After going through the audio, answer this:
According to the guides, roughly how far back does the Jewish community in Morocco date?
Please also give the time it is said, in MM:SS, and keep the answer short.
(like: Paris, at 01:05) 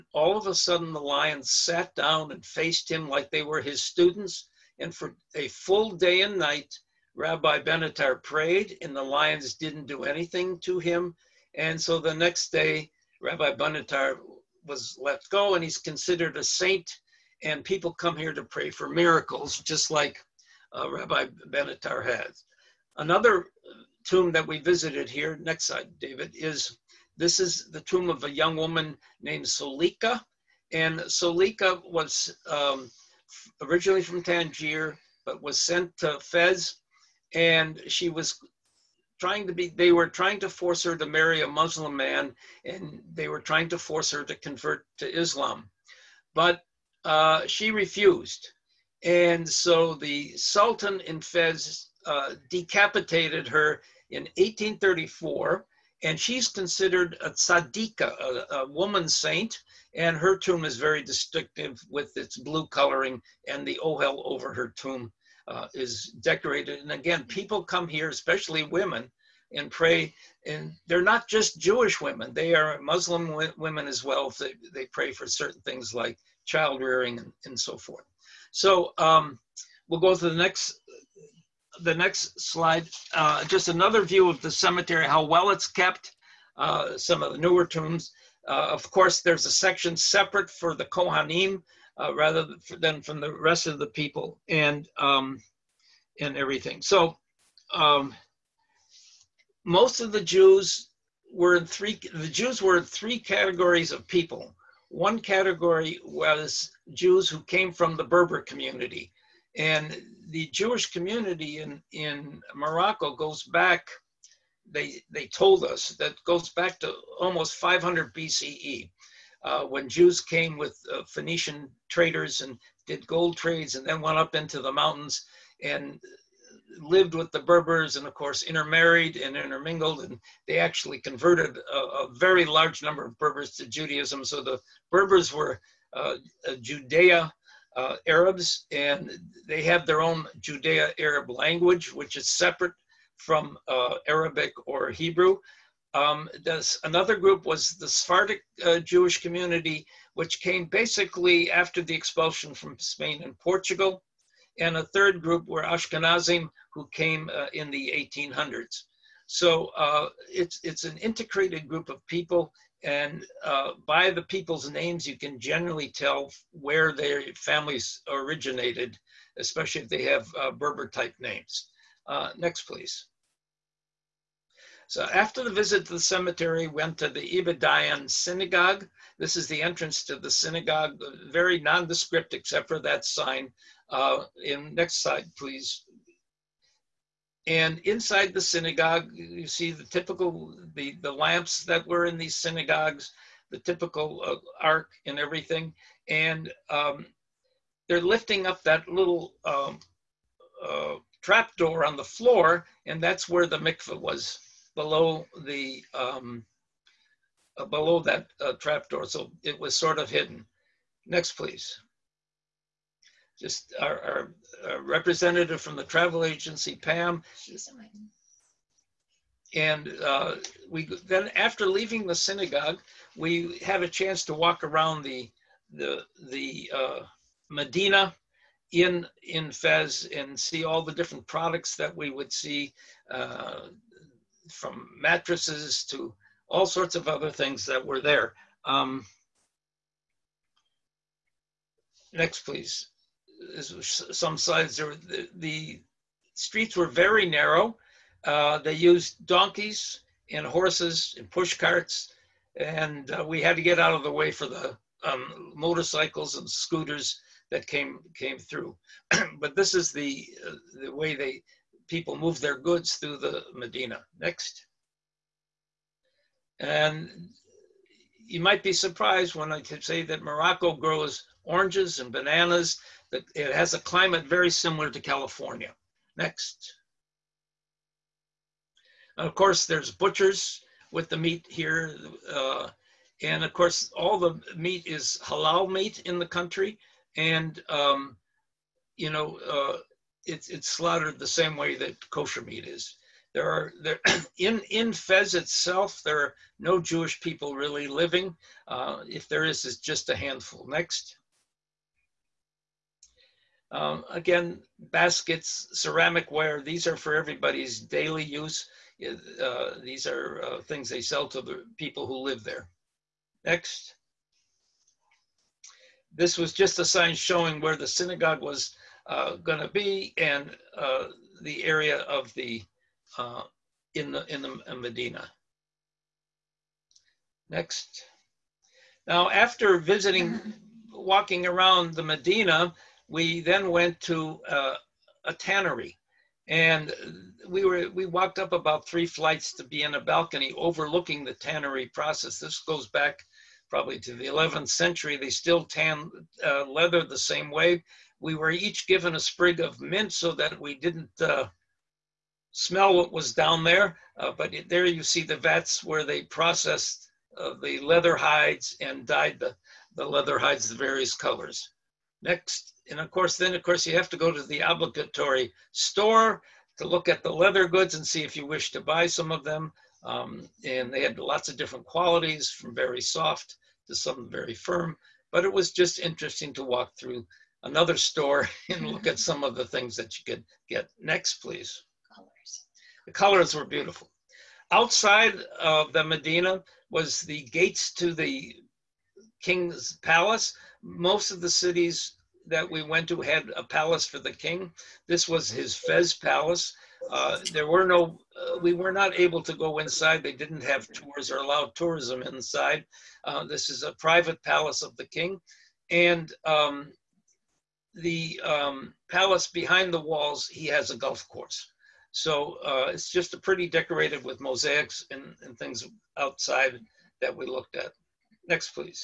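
500 BCE, at 01:57.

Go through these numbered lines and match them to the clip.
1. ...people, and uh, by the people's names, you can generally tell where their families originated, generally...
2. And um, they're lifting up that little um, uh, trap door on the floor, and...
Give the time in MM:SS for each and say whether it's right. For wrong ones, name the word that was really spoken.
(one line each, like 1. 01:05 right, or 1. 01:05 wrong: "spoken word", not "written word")
1. 02:42 wrong: "especially", not "generally"
2. 03:16 right.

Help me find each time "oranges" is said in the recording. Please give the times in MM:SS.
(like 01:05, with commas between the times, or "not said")
04:31.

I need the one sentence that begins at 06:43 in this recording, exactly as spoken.
Uh, this is a private palace of the king.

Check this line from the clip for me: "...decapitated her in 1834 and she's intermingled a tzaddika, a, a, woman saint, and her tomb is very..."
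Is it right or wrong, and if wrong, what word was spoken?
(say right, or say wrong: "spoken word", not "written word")
wrong: "considered", not "intermingled".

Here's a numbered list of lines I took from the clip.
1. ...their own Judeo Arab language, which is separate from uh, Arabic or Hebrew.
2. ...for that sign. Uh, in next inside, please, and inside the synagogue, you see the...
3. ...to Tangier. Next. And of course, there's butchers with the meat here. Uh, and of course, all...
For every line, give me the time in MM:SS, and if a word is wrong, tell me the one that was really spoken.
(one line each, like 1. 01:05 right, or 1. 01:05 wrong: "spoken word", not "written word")
1. 02:19 right
2. 03:02 wrong: "slide", not "inside"
3. 04:34 wrong: "California", not "Tangier".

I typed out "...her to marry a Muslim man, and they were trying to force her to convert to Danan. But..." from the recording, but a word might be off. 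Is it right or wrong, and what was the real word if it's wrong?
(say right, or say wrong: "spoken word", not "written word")
wrong: "Islam", not "Danan".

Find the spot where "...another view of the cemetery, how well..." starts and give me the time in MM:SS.
01:23.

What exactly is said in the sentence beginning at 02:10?
And they actually converted a, a very large number of Berbers to Judaism.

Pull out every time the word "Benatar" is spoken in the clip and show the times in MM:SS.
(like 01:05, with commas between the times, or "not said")
00:07, 00:13, 00:21.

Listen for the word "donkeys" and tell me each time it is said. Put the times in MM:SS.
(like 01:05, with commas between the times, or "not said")
04:09.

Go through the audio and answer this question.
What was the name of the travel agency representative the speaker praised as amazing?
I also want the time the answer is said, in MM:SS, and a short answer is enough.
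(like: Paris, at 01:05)
Pam, at 03:36.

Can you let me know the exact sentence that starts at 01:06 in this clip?
And again, people come here, especially women, and pray.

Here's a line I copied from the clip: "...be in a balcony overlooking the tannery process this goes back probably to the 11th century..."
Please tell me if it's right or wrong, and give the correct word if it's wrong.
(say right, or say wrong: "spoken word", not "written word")
right.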